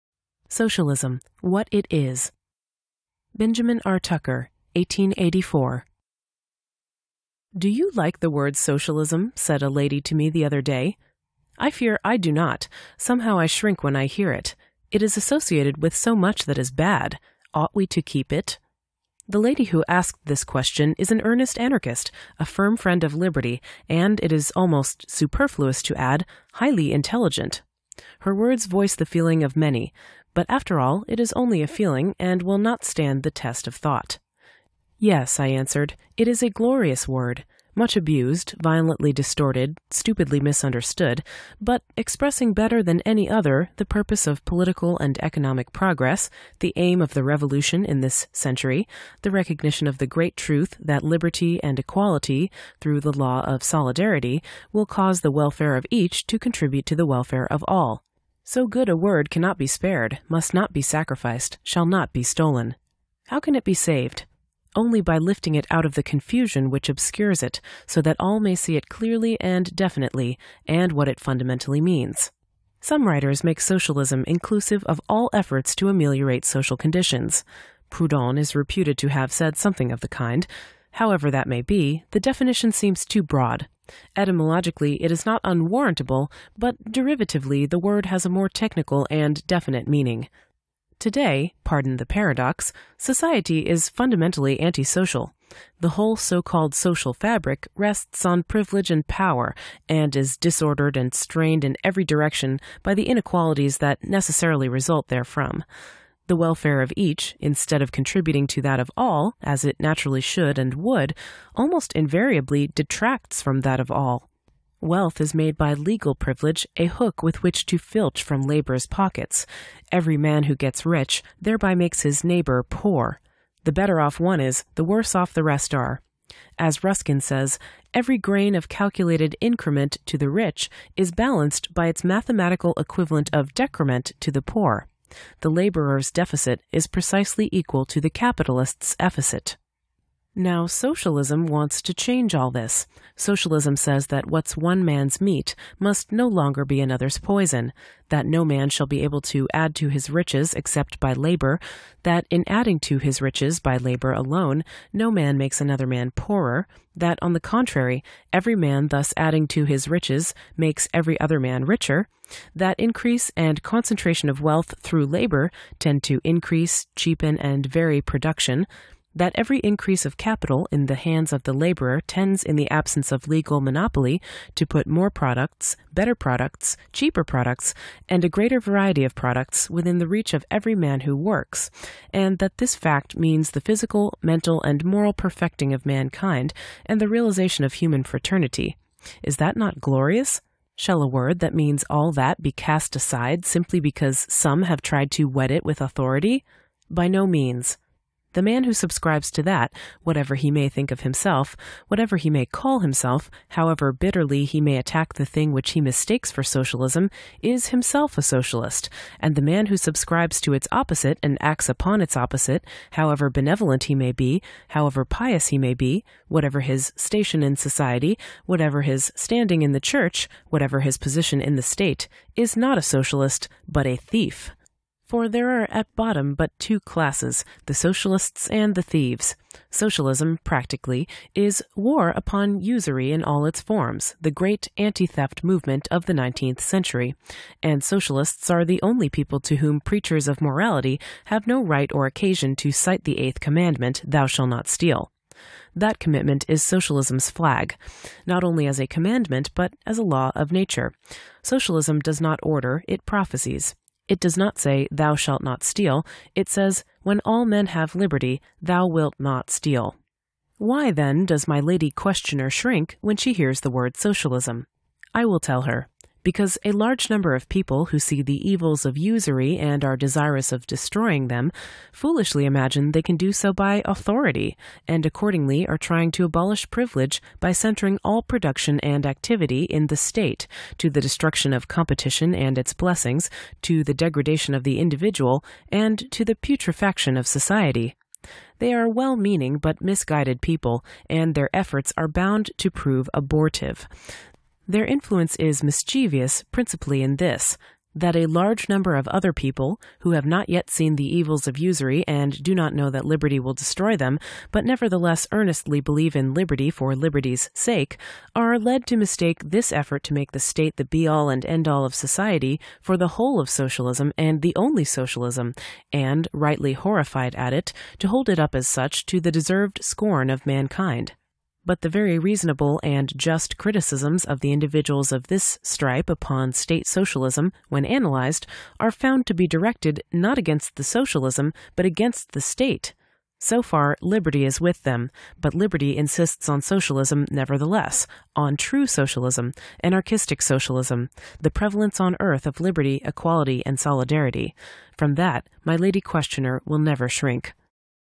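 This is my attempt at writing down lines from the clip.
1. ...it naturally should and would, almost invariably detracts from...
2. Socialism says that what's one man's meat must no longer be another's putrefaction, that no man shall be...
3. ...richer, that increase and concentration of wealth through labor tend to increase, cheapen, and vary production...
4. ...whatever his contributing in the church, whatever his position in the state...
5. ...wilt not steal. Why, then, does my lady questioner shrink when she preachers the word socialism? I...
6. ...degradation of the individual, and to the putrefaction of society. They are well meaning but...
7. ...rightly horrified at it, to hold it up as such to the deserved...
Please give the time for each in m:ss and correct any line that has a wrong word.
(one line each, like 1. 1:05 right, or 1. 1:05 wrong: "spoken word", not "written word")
1. 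1:49 right
2. 2:23 wrong: "poison", not "putrefaction"
3. 2:41 right
4. 3:38 wrong: "standing", not "contributing"
5. 4:18 wrong: "hears", not "preachers"
6. 4:43 right
7. 5:16 right.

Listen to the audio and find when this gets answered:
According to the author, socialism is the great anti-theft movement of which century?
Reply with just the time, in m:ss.
3:56.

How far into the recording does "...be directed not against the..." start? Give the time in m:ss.
5:29.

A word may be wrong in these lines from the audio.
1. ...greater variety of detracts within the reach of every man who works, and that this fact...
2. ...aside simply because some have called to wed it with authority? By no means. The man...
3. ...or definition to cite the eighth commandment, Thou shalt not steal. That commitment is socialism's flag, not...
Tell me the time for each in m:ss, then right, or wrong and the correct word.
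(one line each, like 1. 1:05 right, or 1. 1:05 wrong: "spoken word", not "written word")
1. 2:58 wrong: "products", not "detracts"
2. 3:12 wrong: "tried", not "called"
3. 4:01 wrong: "occasion", not "definition".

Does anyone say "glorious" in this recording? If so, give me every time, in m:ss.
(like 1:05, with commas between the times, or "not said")
0:36, 3:09.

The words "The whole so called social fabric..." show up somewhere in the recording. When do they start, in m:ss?
1:35.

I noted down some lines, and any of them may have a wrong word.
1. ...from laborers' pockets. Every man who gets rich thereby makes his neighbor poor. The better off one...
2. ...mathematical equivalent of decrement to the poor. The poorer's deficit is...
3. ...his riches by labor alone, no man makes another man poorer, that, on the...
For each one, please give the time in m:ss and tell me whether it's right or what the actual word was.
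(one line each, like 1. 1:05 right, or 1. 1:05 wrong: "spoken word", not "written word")
1. 1:58 right
2. 2:12 wrong: "laborer", not "poorer"
3. 2:32 right.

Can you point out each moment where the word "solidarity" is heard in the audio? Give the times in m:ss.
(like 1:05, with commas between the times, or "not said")
0:53, 5:43.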